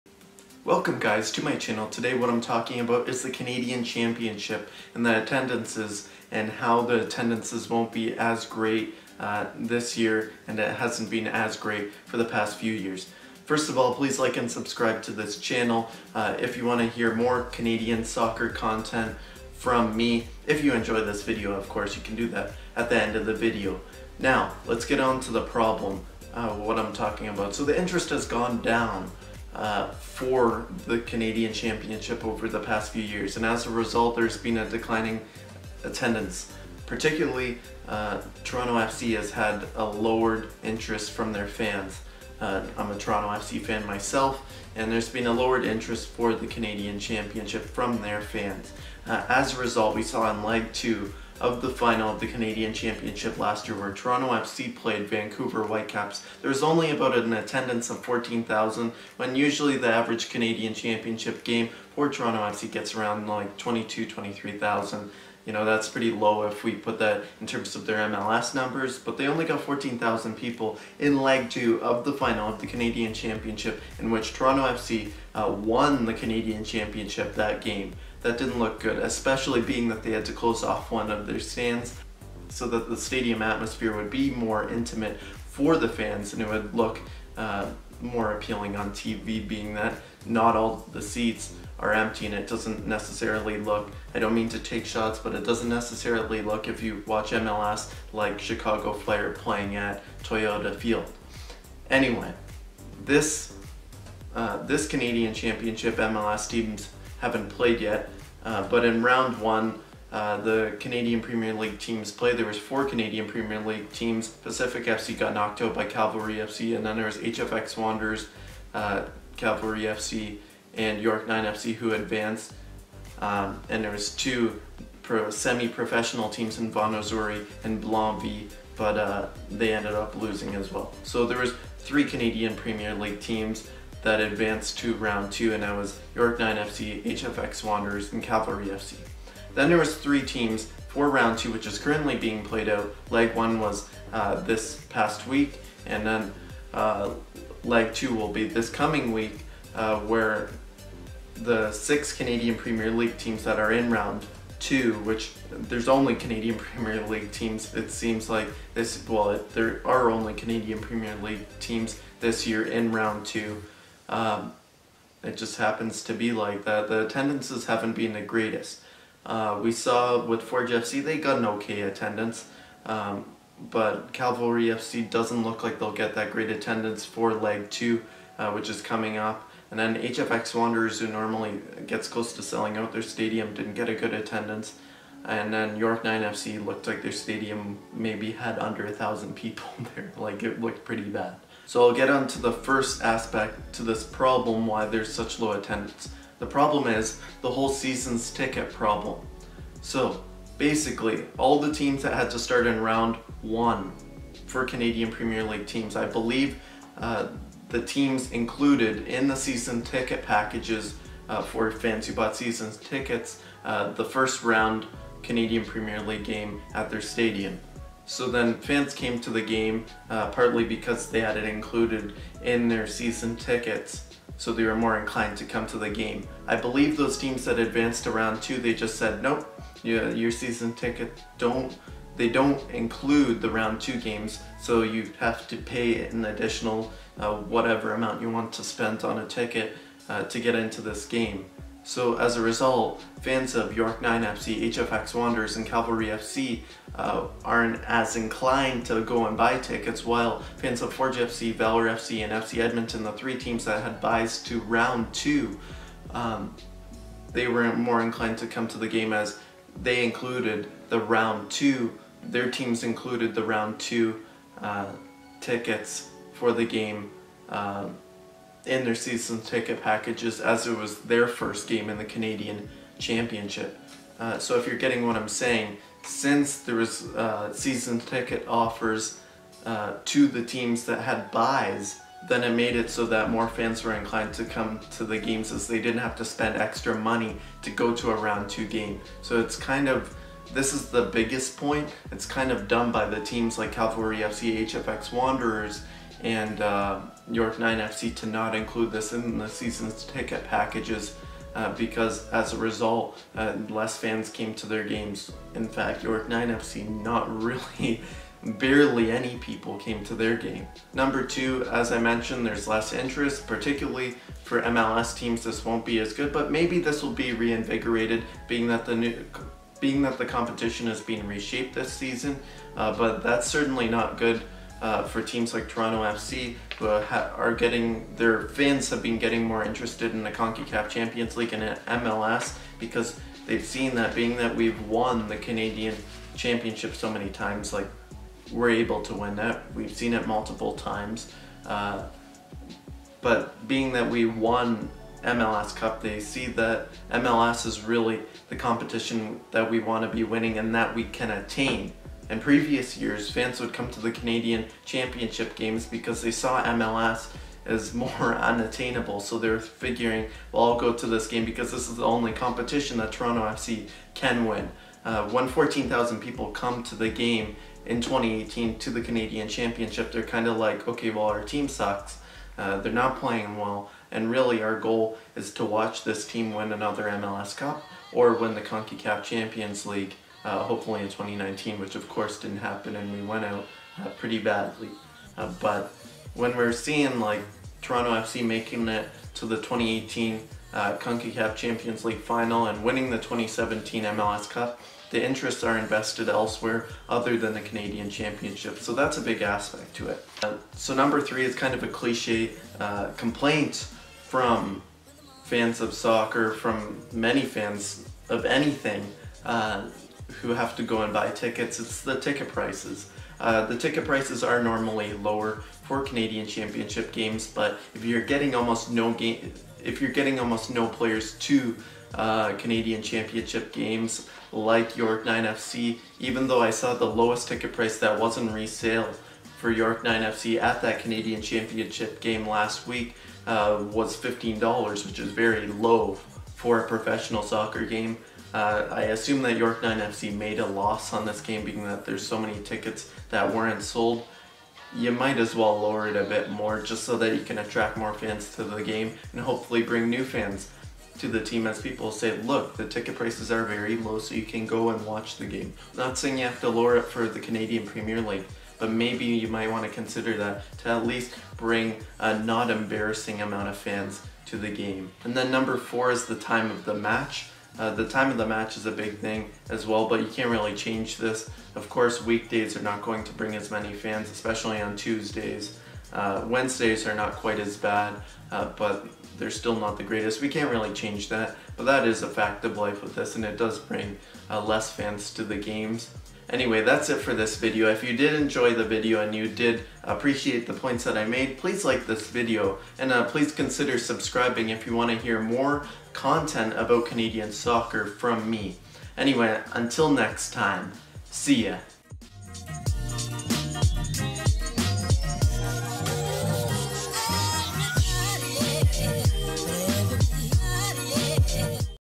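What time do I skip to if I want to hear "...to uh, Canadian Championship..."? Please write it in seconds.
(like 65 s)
421 s.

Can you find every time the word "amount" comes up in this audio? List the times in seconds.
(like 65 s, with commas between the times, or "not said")
237 s, 463 s.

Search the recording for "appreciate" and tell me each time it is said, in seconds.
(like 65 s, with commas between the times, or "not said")
490 s.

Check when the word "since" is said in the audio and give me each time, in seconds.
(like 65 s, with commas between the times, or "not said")
276 s.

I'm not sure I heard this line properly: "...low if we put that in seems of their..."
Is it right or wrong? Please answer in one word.
wrong.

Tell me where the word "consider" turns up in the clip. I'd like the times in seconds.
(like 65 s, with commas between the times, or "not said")
459 s, 493 s.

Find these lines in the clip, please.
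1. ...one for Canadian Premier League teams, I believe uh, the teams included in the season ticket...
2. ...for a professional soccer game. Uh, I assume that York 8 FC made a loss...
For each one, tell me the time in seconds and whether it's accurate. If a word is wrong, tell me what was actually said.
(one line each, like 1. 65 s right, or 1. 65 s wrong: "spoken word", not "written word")
1. 203 s right
2. 436 s wrong: "9", not "8".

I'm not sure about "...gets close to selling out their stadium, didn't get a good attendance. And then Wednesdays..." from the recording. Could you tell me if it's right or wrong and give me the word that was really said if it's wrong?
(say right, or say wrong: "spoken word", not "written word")
wrong: "York", not "Wednesdays".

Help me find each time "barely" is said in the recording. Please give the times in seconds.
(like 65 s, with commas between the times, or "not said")
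308 s.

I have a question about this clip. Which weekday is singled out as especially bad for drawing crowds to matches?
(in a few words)
Tuesdays.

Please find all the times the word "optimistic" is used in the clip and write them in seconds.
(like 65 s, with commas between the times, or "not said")
not said.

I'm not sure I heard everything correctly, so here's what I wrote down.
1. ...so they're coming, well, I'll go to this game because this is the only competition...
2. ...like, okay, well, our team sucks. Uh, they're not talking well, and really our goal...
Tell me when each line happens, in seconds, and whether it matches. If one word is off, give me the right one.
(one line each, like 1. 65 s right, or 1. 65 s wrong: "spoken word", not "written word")
1. 359 s wrong: "figuring", not "coming"
2. 370 s wrong: "playing", not "talking".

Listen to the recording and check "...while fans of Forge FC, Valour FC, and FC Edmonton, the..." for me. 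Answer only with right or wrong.
right.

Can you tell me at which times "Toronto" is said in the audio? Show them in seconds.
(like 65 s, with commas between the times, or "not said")
38 s, 42 s, 53 s, 62 s, 74 s, 325 s, 363 s, 387 s.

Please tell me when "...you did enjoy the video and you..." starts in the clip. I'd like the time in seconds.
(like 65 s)
488 s.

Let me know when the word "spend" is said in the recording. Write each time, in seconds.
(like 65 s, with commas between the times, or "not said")
238 s, 286 s.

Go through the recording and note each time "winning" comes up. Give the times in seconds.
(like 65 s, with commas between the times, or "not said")
350 s, 392 s.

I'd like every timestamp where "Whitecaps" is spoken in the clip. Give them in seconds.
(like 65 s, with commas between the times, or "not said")
55 s.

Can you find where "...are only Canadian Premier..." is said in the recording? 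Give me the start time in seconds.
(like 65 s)
159 s.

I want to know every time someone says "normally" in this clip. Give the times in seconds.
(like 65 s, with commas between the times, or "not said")
181 s, 414 s.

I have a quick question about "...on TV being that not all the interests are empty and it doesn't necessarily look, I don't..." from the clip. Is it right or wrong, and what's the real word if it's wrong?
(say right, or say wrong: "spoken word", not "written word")
wrong: "seats", not "interests".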